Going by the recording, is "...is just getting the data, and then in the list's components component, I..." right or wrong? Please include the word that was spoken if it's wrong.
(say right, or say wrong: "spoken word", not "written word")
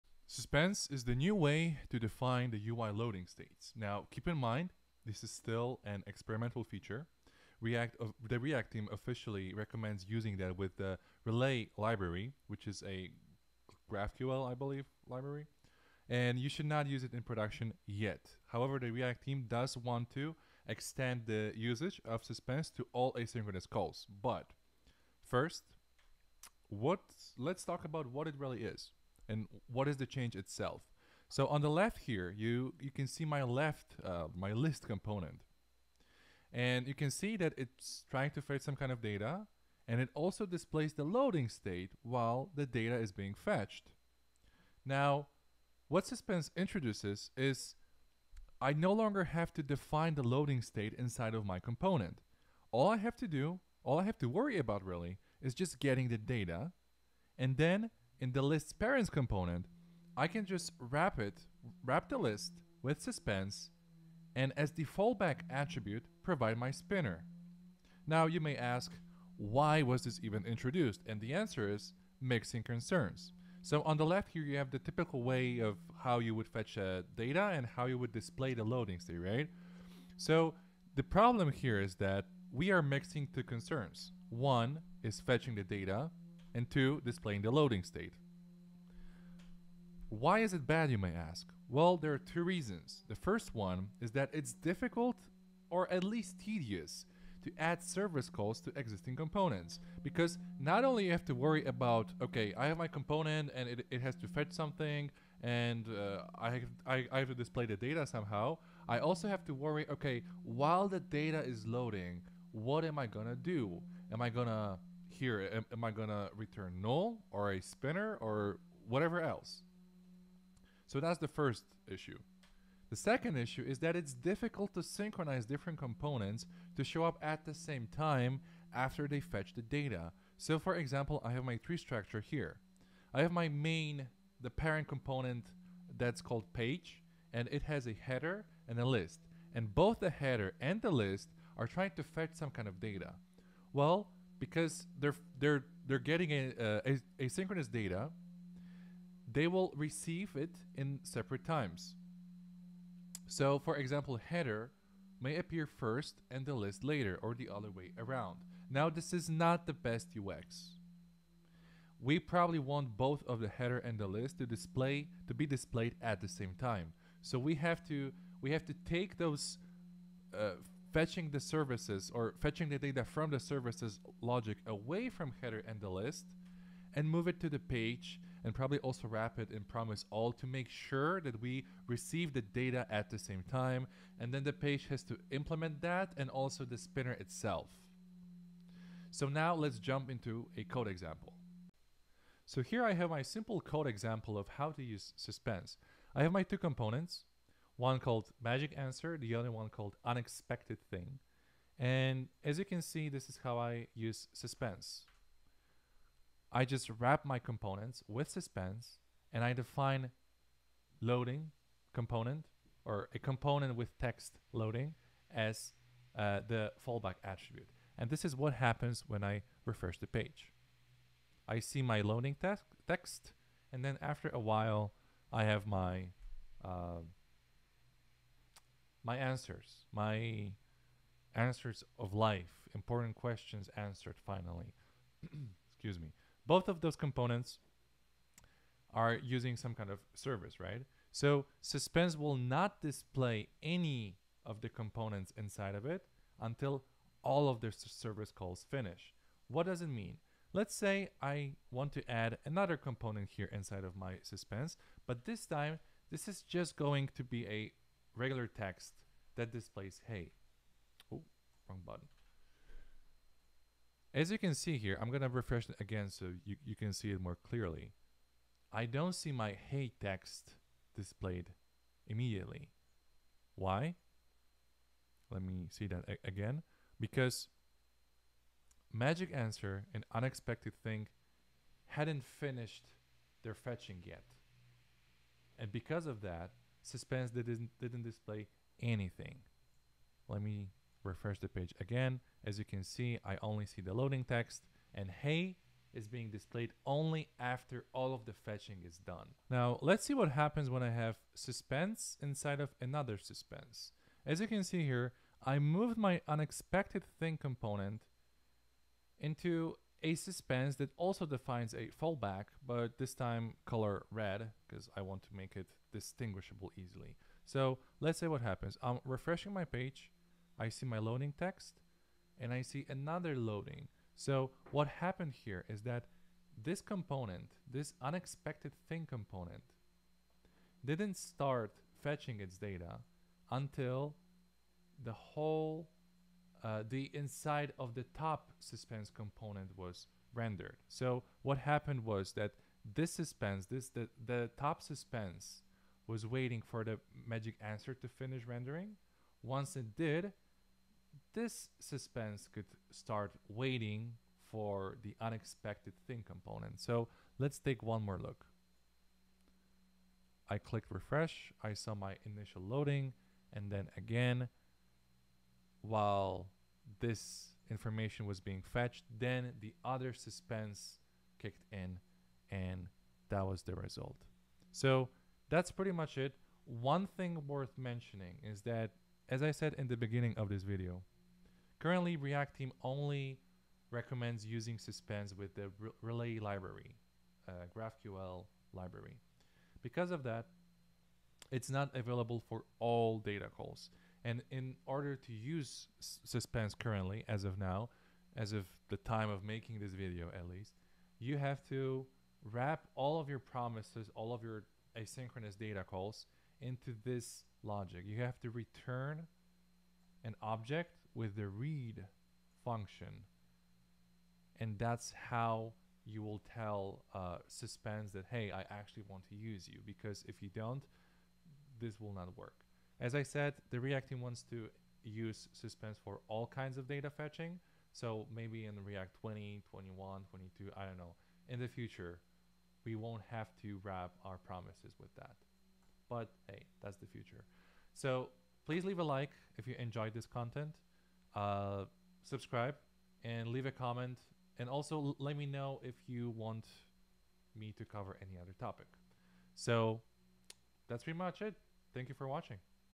wrong: "parents", not "components".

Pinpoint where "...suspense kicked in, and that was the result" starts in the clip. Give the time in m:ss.
6:10.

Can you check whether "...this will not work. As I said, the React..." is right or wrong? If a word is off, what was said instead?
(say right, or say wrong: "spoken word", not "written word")
right.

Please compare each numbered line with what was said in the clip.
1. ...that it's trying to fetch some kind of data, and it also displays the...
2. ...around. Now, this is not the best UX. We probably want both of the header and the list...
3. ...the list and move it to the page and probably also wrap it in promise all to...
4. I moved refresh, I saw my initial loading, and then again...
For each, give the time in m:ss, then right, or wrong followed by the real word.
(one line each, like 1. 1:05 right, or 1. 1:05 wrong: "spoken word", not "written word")
1. 0:37 right
2. 2:37 right
3. 2:55 right
4. 6:00 wrong: "clicked", not "moved".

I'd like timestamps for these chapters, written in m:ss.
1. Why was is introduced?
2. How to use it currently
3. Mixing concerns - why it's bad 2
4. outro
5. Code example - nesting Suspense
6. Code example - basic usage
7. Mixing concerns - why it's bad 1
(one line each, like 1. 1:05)
1. 1:08
2. 6:19
3. 2:02
4. 7:18
5. 4:58
6. 3:10
7. 1:29.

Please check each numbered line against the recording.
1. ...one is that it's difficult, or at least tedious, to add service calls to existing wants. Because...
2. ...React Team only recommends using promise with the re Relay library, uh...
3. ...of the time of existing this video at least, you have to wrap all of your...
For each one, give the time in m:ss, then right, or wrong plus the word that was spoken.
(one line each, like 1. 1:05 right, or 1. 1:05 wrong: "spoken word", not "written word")
1. 1:33 wrong: "components", not "wants"
2. 6:22 wrong: "suspense", not "promise"
3. 6:38 wrong: "making", not "existing".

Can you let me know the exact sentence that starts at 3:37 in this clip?
And this is what happens when I refresh the page.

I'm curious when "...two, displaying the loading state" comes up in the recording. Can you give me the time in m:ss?
1:26.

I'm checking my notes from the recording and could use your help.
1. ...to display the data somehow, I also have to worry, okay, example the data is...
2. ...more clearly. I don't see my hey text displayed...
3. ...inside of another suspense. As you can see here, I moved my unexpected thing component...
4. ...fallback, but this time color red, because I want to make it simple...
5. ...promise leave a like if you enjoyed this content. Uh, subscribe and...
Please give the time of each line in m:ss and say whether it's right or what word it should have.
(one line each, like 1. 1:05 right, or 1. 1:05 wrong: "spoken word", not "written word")
1. 1:47 wrong: "while", not "example"
2. 4:27 right
3. 5:02 right
4. 5:12 wrong: "distinguishable", not "simple"
5. 7:18 wrong: "please", not "promise".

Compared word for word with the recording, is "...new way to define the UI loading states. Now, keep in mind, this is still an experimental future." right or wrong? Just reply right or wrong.
wrong.